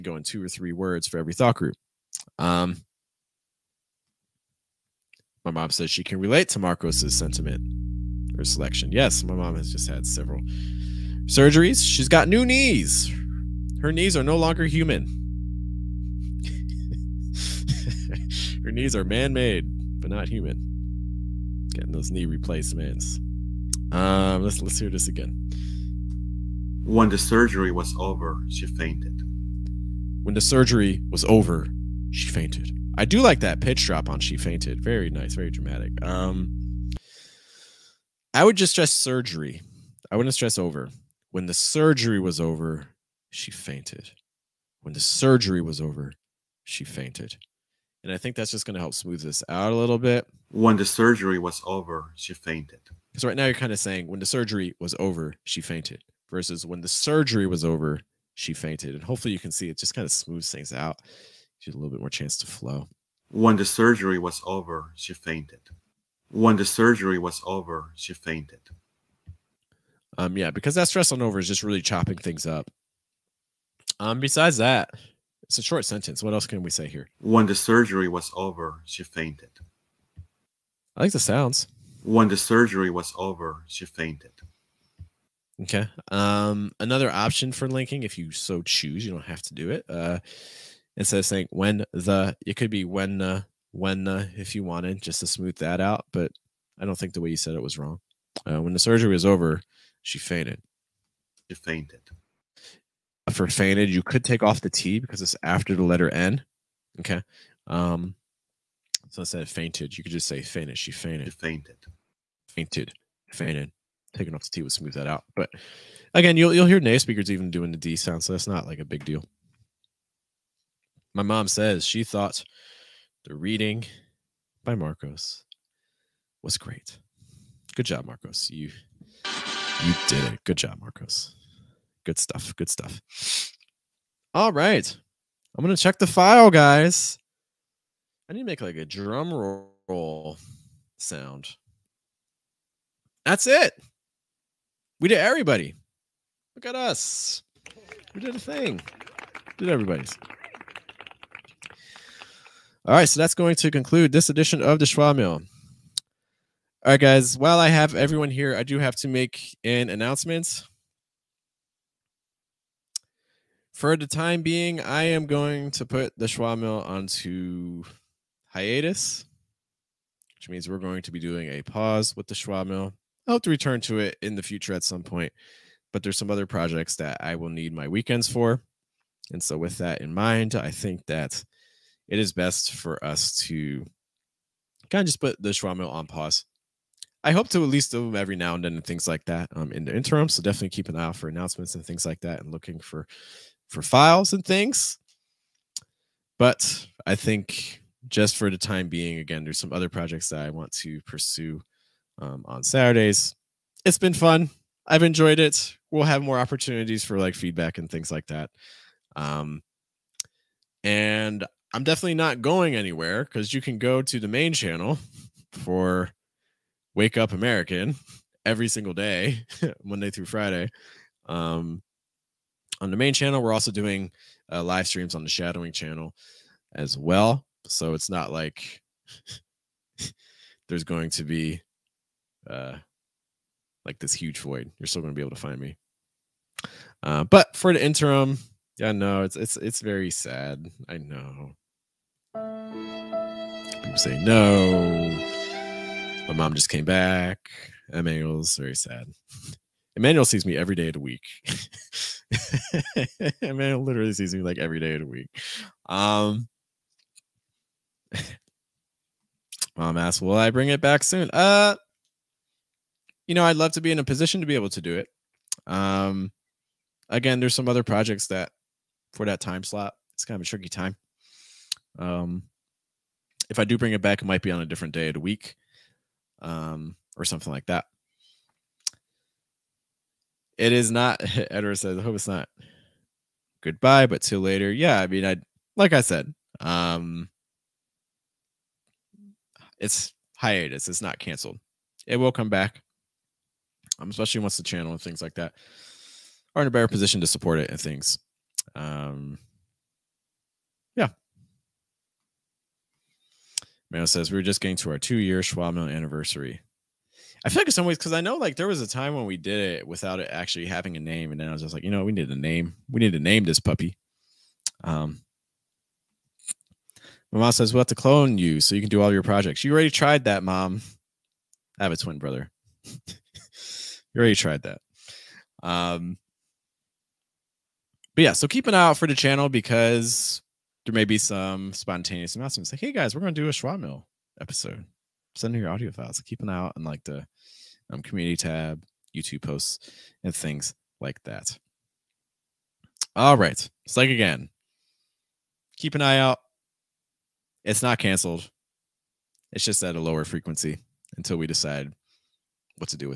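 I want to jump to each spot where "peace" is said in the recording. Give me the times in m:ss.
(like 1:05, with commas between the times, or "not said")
not said.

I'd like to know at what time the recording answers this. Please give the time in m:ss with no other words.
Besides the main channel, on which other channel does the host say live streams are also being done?
3:45.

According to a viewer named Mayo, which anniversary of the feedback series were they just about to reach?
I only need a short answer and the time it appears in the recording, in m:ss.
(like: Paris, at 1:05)
2-year, at 5:04.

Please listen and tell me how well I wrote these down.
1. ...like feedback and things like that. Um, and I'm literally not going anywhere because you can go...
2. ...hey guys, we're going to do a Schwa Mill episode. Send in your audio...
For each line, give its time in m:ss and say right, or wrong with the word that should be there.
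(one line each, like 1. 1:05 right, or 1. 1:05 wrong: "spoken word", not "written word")
1. 3:27 wrong: "definitely", not "literally"
2. 5:32 right.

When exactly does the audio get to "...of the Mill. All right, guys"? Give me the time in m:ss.
2:34.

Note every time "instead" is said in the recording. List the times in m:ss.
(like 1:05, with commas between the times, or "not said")
1:30, 1:49.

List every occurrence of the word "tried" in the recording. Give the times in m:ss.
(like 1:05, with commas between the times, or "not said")
5:19, 5:24.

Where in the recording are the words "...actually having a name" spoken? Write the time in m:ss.
5:10.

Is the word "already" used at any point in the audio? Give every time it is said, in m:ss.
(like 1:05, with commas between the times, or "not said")
5:19, 5:24.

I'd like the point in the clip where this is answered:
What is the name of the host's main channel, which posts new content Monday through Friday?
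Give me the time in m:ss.
3:36.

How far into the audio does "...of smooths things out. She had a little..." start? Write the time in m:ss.
1:00.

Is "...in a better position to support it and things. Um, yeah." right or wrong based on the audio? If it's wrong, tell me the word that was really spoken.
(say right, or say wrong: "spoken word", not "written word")
right.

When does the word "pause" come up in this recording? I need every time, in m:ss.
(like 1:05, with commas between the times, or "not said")
2:51, 3:06.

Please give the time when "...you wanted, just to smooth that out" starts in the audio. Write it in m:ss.
1:34.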